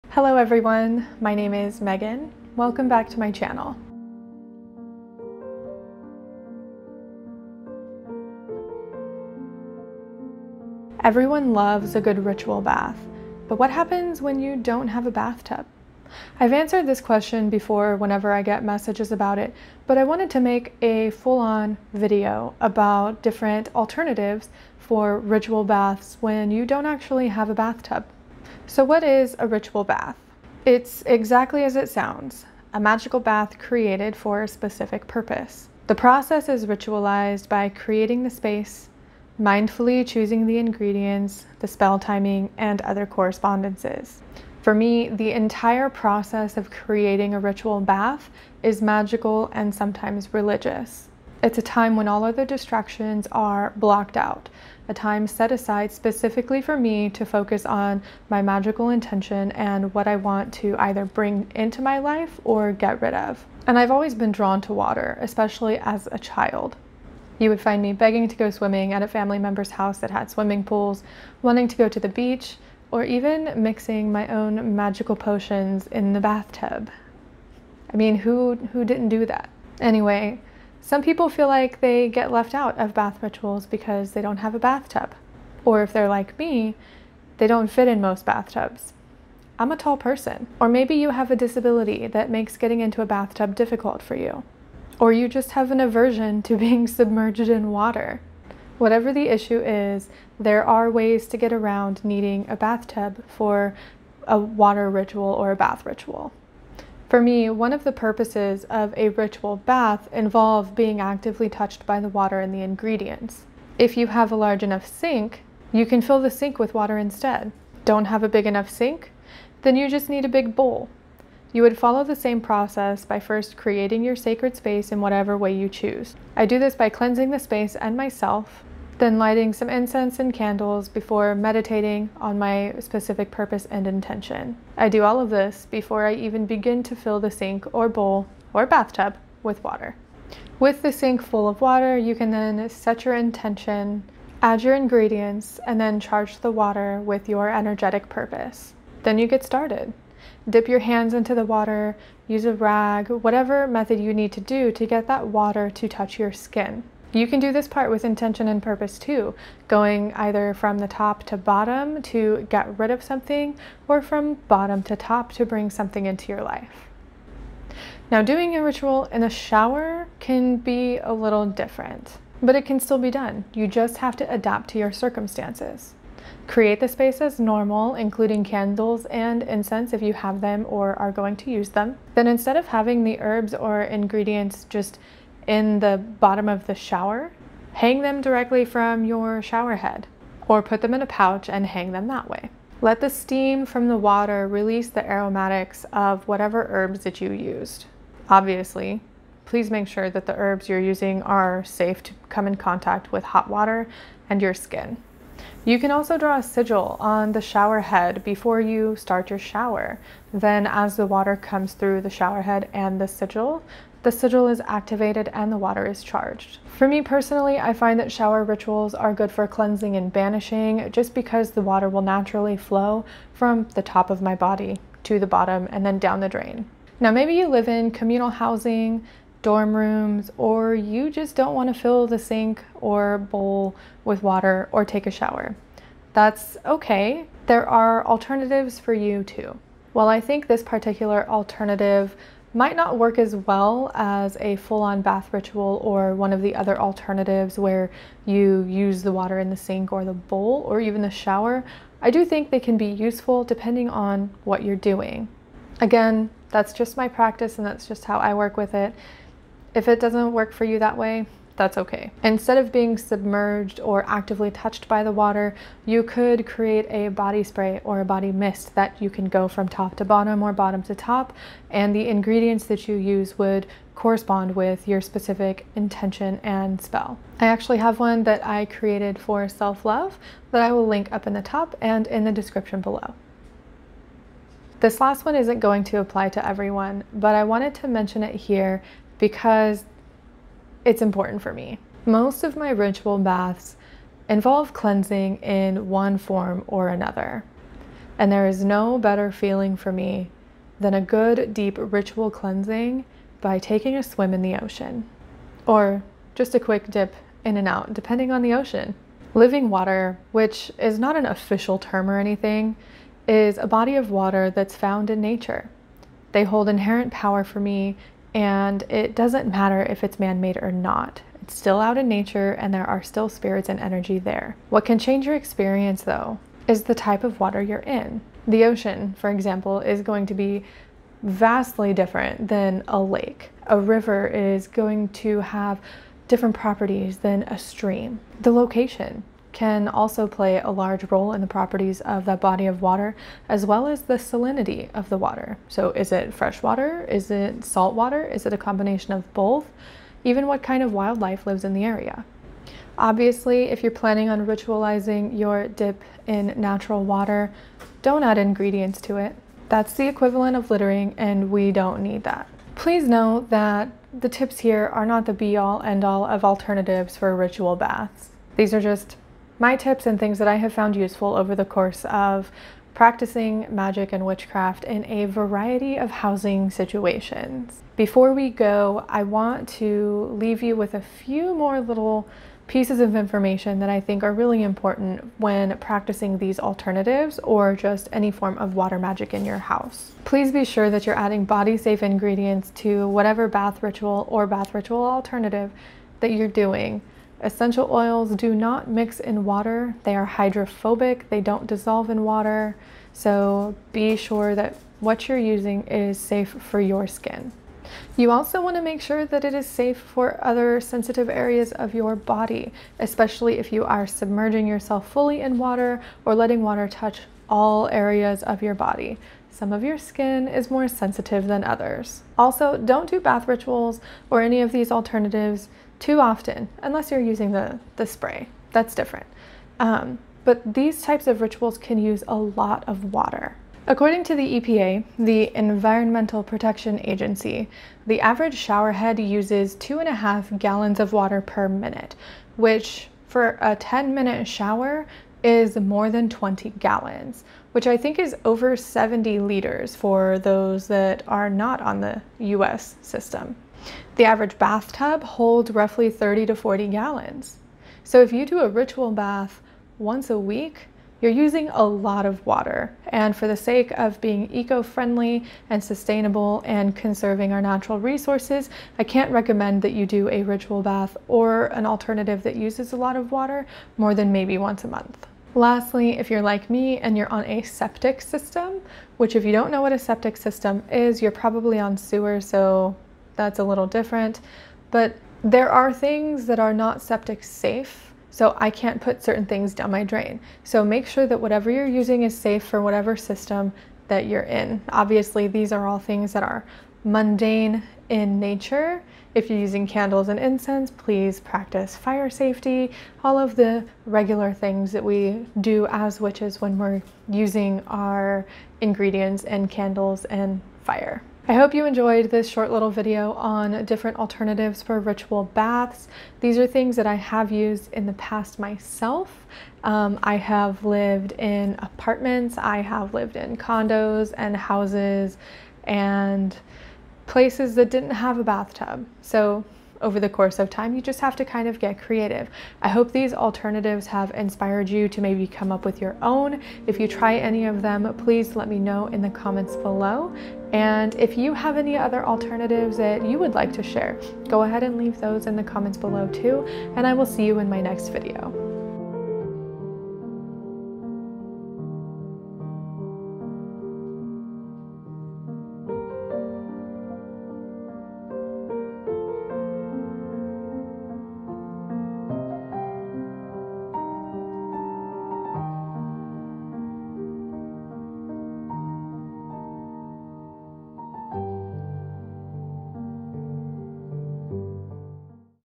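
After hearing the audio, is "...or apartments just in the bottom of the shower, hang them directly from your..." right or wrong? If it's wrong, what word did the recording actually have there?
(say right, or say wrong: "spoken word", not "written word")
wrong: "ingredients", not "apartments".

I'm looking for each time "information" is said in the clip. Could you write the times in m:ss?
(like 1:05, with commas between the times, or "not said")
6:23.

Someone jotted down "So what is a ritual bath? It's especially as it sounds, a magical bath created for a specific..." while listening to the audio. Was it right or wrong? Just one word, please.
wrong.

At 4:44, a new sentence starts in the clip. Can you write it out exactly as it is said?
This last one isn't going to apply to everyone, but I wanted to mention it here because it's important for me.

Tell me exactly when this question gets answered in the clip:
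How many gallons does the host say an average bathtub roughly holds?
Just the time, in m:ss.
7:36.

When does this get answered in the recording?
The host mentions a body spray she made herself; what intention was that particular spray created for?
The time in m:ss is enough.
4:39.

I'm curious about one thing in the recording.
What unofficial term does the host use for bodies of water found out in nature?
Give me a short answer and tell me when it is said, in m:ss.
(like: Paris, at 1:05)
Living water, at 5:09.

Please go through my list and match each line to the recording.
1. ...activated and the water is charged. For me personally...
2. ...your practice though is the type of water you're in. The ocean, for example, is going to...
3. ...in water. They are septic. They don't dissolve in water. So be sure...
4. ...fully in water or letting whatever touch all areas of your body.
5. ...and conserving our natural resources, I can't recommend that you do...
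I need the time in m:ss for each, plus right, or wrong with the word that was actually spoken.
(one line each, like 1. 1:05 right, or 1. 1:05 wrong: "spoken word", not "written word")
1. 3:34 right
2. 5:25 wrong: "experience", not "practice"
3. 6:39 wrong: "hydrophobic", not "septic"
4. 6:55 wrong: "water", not "whatever"
5. 7:46 right.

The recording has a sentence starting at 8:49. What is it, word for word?
So over the course of time.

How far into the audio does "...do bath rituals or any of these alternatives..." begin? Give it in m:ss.
7:03.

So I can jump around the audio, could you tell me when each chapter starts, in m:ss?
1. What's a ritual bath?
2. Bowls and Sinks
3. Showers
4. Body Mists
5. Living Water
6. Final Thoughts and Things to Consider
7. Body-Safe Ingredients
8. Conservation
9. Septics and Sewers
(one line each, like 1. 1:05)
1. 0:28
2. 1:46
3. 2:47
4. 3:46
5. 4:44
6. 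6:02
7. 6:30
8. 7:02
9. 7:55.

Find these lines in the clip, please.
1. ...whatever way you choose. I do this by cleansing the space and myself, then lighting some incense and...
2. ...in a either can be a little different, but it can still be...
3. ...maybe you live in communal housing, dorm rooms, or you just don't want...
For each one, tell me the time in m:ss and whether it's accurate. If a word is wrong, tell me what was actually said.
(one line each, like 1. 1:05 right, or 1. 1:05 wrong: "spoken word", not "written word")
1. 2:05 right
2. 2:49 wrong: "shower", not "either"
3. 3:47 right.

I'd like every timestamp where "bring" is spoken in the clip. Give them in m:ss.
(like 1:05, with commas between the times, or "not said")
1:01, 2:45.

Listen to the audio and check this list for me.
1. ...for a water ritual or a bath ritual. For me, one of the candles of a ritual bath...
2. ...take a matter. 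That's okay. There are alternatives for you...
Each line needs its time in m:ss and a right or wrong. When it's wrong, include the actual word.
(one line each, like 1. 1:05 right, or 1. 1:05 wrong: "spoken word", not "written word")
1. 1:43 wrong: "purposes", not "candles"
2. 3:54 wrong: "shower", not "matter".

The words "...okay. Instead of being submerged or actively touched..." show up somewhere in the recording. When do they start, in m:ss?
4:21.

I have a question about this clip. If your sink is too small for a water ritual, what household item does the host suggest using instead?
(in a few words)
A big bowl.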